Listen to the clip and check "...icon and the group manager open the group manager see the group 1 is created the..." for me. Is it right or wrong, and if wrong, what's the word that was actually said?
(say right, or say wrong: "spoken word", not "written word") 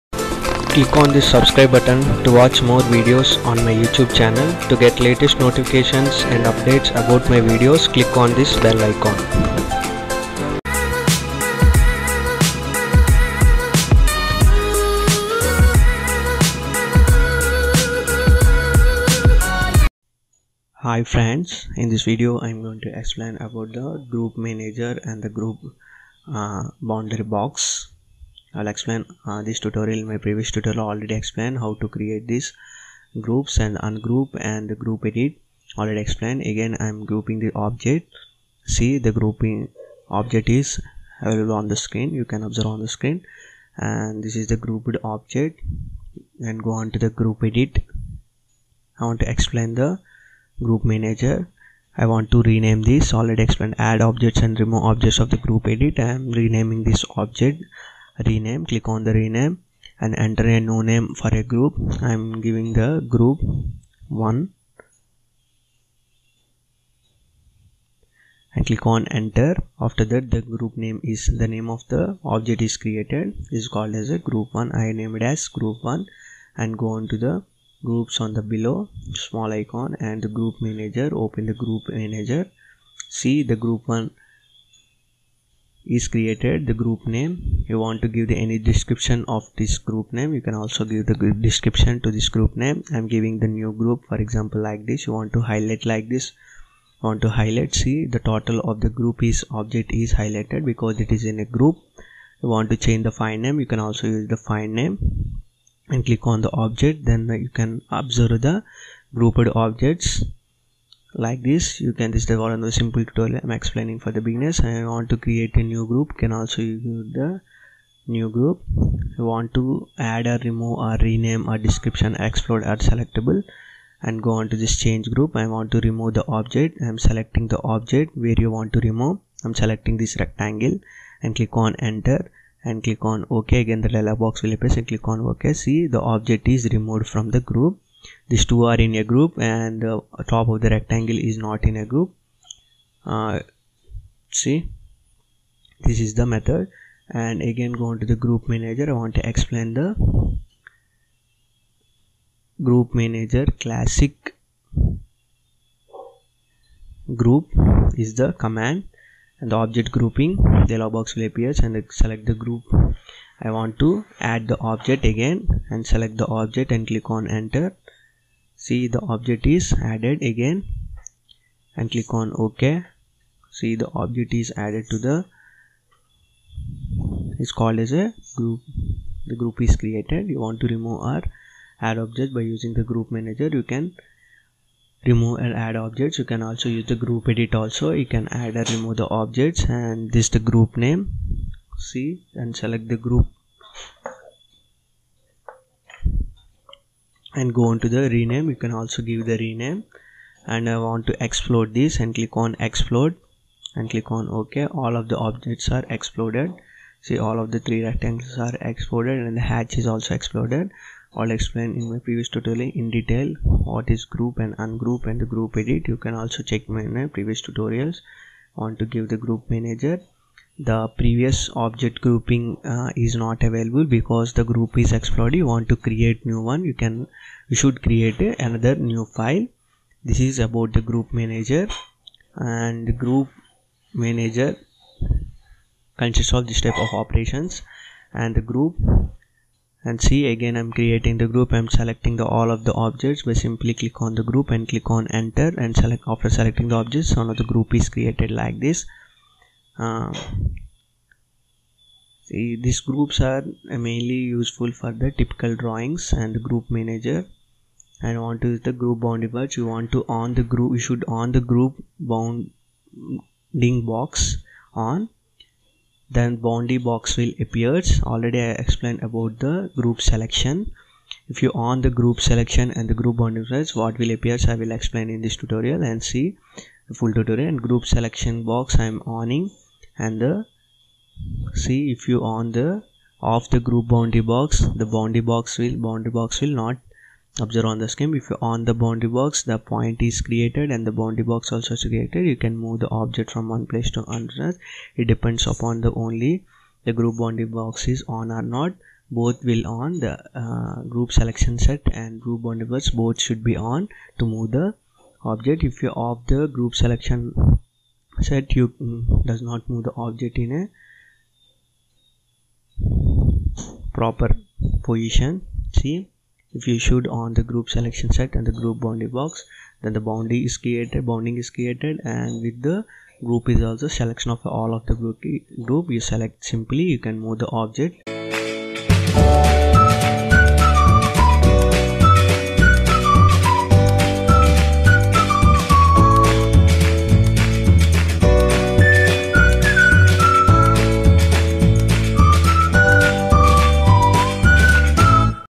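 right.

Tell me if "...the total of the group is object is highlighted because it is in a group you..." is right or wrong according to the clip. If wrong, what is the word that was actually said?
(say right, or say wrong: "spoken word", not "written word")
right.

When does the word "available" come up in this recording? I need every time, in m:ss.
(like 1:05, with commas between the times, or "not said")
0:41, 3:43.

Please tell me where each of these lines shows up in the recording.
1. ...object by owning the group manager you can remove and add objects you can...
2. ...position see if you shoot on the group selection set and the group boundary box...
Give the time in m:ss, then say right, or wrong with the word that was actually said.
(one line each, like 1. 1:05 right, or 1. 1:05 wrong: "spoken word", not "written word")
1. 3:02 wrong: "using", not "owning"
2. 5:14 right.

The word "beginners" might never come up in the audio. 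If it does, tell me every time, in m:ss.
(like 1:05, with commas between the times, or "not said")
1:54.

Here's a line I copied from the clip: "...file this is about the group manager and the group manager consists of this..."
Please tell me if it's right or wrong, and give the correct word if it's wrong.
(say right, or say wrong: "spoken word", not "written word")
right.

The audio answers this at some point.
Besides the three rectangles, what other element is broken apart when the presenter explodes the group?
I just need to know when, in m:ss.
3:29.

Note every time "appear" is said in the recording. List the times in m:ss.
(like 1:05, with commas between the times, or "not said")
2:14, 2:41, 4:27, 4:34.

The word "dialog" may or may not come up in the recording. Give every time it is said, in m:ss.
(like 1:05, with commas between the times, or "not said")
2:13, 2:40.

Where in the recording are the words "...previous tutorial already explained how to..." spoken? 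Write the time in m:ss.
0:30.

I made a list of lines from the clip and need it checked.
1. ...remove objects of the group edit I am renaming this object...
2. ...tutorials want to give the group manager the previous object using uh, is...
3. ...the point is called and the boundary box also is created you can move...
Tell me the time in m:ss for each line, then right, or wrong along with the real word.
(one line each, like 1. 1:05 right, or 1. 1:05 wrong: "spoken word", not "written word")
1. 0:54 right
2. 3:37 wrong: "grouping", not "using"
3. 4:49 wrong: "created", not "called".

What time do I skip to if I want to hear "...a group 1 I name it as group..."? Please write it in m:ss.
1:14.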